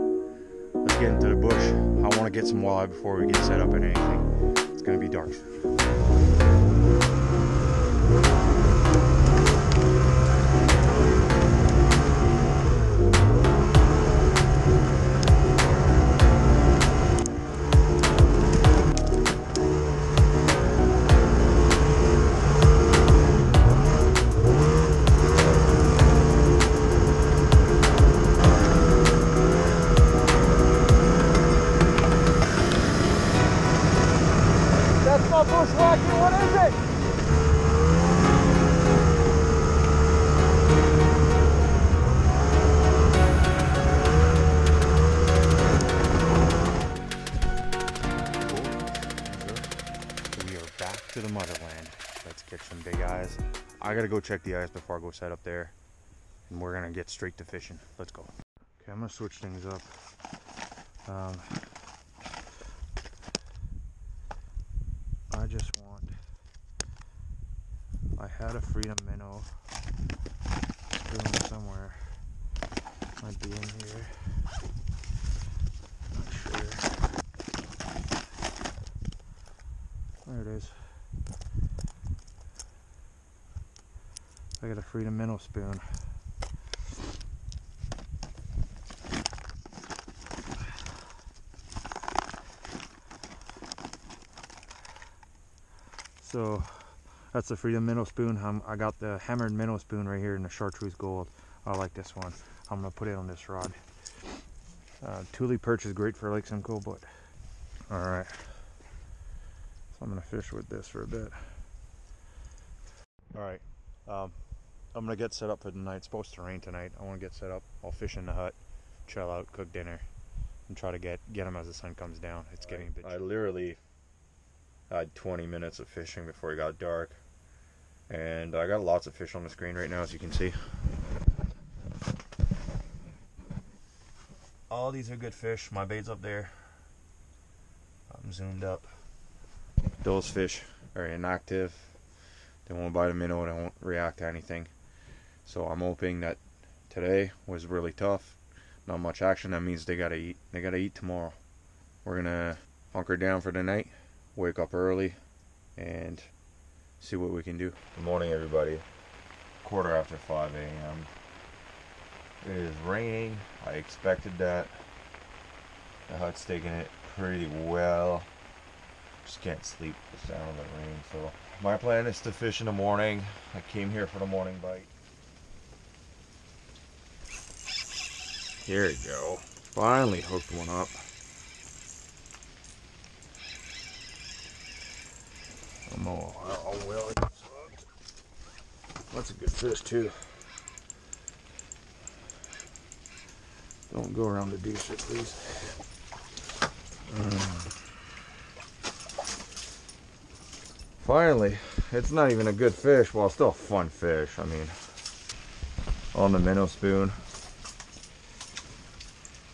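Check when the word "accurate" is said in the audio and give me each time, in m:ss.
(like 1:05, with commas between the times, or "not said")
not said.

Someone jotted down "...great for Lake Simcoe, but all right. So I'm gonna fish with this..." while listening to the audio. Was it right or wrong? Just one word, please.
right.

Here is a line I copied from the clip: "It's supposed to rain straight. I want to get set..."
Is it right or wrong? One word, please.
wrong.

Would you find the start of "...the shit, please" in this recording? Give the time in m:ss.
3:14.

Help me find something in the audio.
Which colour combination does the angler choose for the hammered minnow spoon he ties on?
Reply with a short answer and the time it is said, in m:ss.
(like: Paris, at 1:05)
Chartreuse gold, at 1:40.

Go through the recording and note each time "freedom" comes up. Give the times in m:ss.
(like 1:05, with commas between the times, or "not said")
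1:08, 1:24, 1:37.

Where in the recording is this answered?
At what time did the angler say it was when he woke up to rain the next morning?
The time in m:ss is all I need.
2:39.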